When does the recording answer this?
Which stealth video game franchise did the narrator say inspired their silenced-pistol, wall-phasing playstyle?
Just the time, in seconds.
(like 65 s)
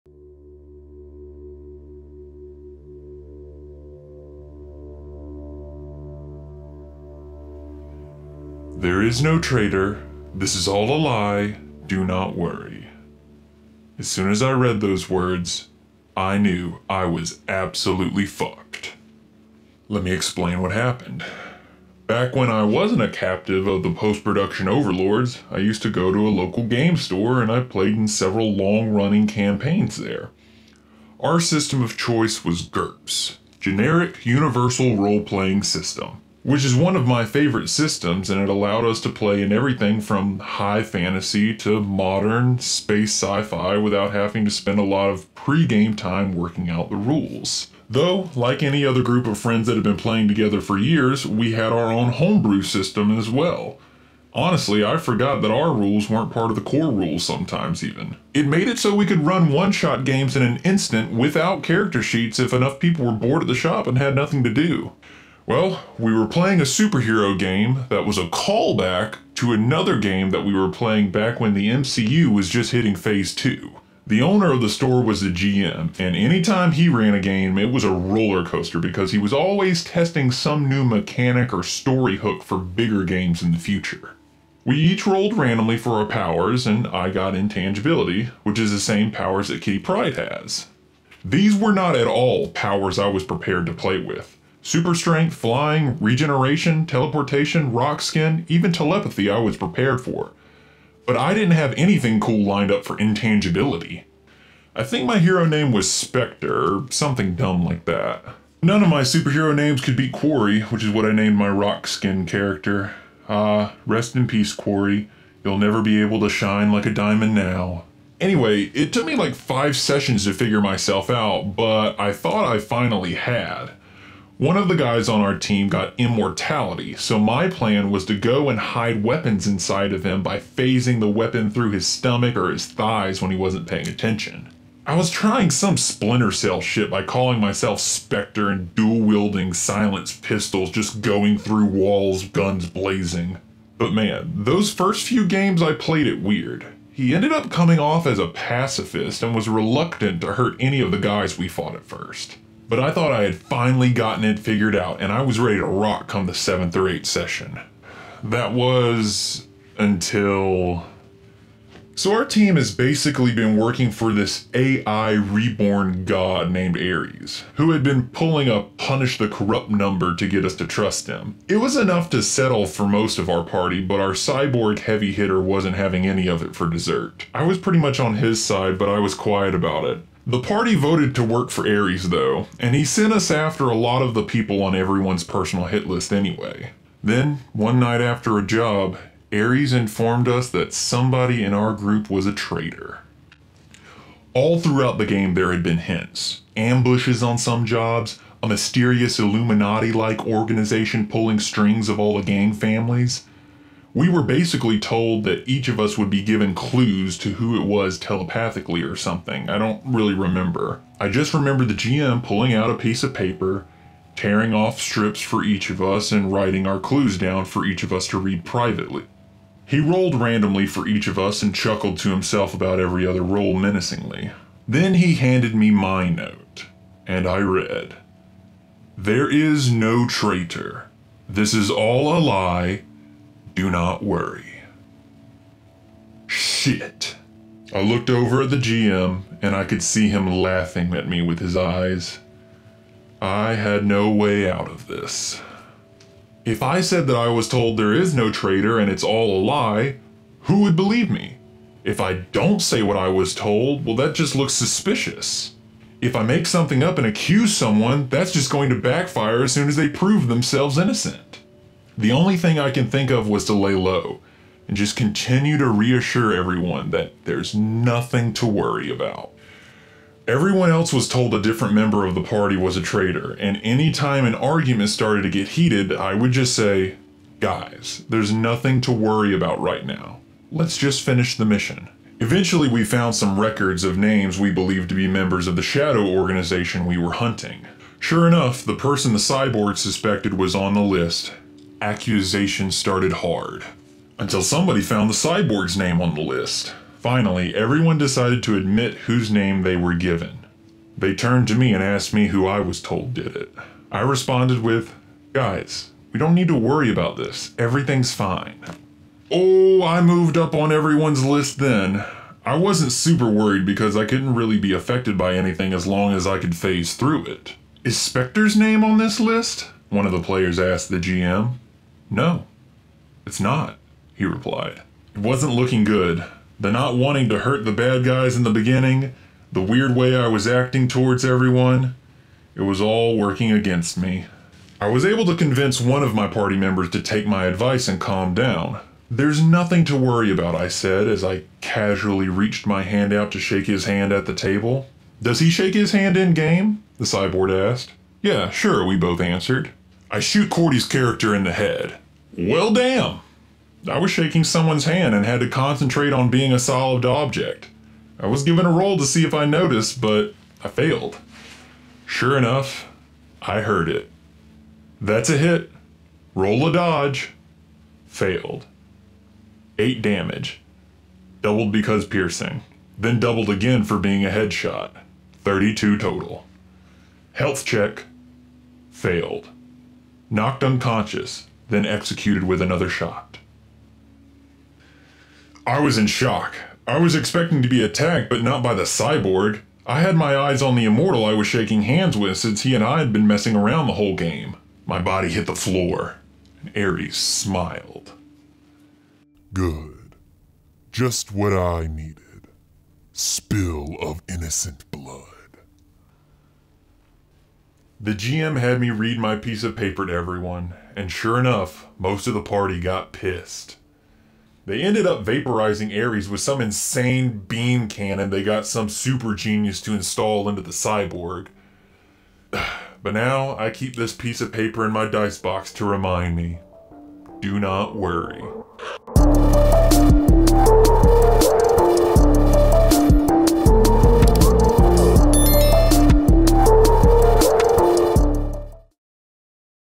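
135 s.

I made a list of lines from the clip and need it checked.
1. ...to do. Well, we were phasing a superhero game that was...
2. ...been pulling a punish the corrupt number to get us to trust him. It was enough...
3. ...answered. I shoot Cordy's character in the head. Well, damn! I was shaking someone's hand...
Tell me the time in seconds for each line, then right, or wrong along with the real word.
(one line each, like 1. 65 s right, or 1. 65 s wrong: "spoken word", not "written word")
1. 64 s wrong: "playing", not "phasing"
2. 167 s right
3. 349 s right.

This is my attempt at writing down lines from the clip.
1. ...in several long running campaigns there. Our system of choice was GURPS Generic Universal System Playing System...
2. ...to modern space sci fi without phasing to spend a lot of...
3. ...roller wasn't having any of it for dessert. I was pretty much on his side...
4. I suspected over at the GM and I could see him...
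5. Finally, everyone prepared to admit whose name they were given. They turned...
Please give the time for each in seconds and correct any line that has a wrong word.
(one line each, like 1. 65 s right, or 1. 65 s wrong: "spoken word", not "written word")
1. 27 s wrong: "Role", not "System"
2. 41 s wrong: "having", not "phasing"
3. 175 s wrong: "hitter", not "roller"
4. 237 s wrong: "looked", not "suspected"
5. 296 s wrong: "decided", not "prepared".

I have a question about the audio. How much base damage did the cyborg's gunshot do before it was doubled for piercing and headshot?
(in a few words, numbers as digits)
8.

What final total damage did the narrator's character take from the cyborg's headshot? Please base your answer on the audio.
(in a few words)
32.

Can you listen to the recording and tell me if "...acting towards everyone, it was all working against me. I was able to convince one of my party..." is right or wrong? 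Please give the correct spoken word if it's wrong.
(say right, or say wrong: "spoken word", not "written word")
right.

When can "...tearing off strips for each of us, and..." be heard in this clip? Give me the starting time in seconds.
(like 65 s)
214 s.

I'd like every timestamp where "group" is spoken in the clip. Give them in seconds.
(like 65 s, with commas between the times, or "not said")
49 s, 191 s.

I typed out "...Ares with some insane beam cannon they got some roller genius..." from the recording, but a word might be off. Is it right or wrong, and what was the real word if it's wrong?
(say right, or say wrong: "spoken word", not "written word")
wrong: "super", not "roller".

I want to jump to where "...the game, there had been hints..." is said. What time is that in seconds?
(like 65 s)
194 s.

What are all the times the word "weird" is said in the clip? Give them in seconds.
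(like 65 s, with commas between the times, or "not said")
146 s, 329 s.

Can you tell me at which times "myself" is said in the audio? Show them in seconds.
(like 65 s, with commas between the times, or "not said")
120 s, 137 s.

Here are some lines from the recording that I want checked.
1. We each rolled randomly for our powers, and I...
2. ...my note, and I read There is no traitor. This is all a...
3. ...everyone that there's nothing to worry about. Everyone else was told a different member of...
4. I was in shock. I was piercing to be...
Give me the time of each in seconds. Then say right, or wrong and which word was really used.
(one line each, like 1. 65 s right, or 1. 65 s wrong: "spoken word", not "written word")
1. 84 s right
2. 225 s right
3. 266 s right
4. 385 s wrong: "expecting", not "piercing".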